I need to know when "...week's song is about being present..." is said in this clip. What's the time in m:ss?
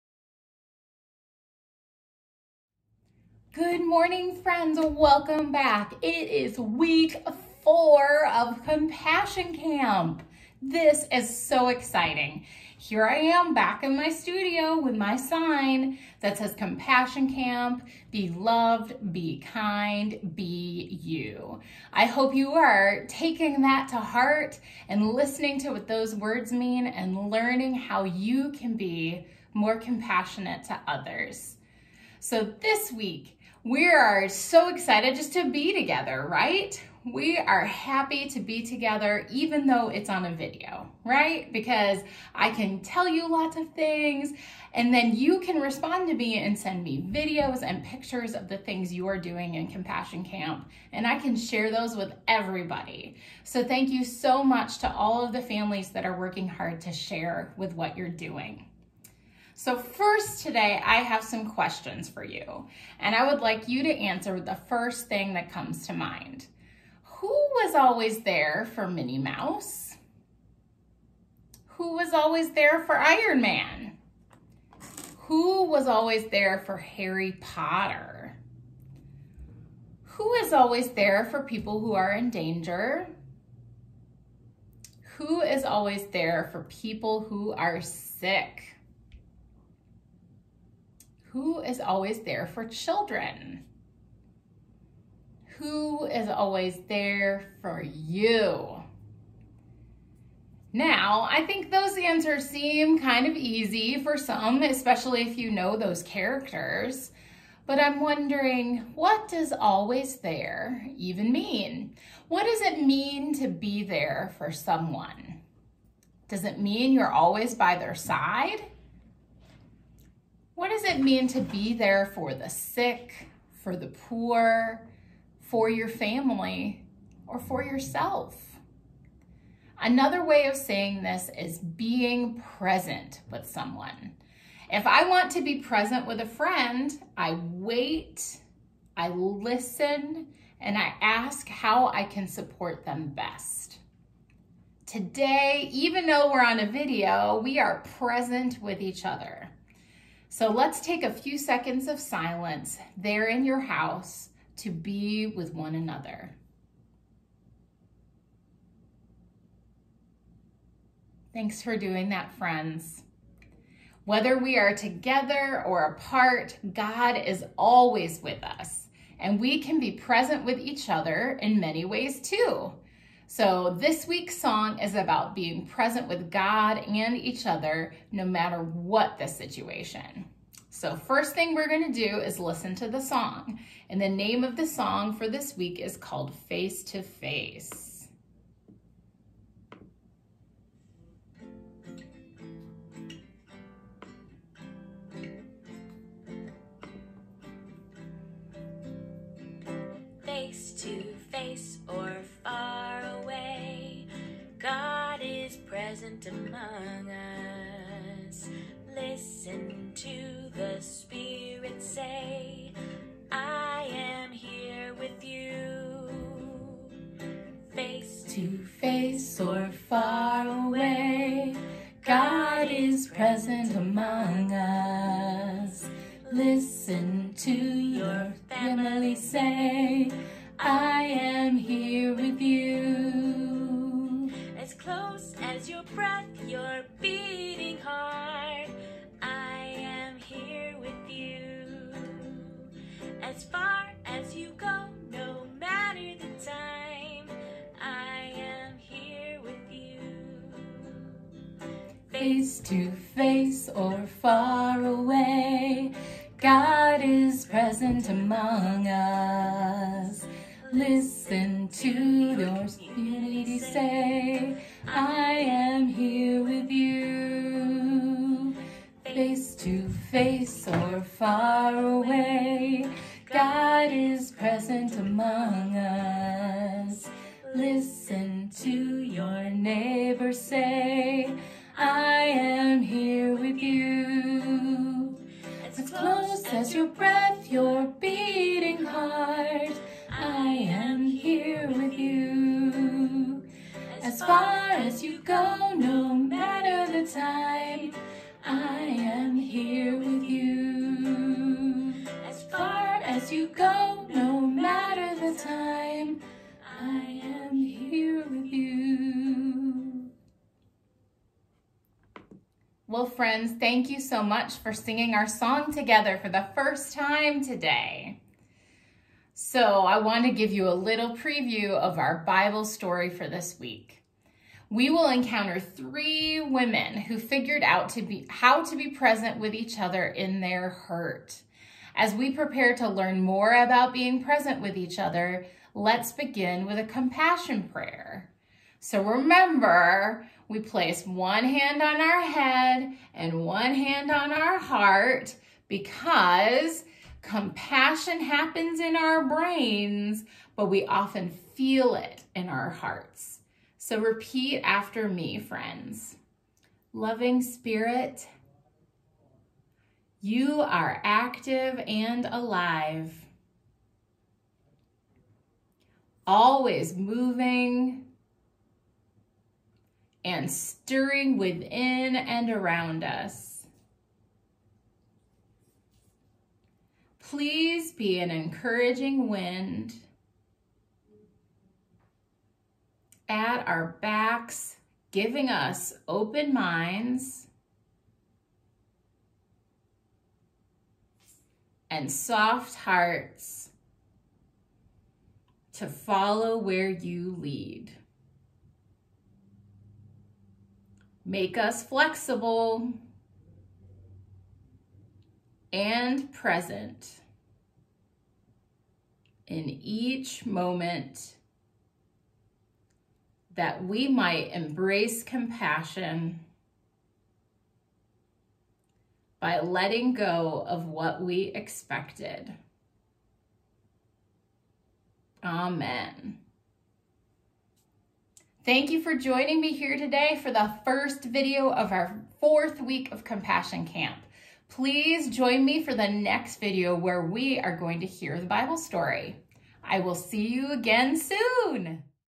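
2:54.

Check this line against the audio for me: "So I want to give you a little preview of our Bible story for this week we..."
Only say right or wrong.
right.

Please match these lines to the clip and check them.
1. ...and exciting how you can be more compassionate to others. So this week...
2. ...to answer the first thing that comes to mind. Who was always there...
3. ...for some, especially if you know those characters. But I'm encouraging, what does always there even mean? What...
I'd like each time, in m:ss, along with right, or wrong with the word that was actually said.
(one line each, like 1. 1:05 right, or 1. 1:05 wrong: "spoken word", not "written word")
1. 0:26 wrong: "learning", not "exciting"
2. 1:03 right
3. 1:44 wrong: "wondering", not "encouraging".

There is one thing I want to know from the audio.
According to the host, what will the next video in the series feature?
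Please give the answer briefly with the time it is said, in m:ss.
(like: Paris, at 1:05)
the Bible story, at 7:18.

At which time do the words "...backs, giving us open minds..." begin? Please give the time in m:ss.
6:24.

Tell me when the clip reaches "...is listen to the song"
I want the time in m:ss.
3:02.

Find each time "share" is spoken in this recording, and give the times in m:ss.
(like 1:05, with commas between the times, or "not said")
0:51, 0:56.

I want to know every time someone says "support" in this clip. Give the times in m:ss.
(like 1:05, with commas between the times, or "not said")
2:22.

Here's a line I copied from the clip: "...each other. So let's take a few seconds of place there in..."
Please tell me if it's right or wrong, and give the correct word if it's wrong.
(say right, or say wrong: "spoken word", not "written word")
wrong: "silence", not "place".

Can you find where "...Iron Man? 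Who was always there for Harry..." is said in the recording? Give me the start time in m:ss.
1:12.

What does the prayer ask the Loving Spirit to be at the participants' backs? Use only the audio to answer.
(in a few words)
an encouraging wind.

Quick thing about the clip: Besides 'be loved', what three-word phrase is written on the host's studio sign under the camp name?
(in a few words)
be kind, be you.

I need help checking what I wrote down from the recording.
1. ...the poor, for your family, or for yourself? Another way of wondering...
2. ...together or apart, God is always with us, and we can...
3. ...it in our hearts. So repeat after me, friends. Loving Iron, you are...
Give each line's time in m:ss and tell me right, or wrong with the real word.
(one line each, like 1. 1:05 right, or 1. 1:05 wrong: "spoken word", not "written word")
1. 2:03 wrong: "saying", not "wondering"
2. 2:44 right
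3. 5:51 wrong: "Spirit", not "Iron".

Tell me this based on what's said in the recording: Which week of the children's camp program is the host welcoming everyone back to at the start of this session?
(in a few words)
week four.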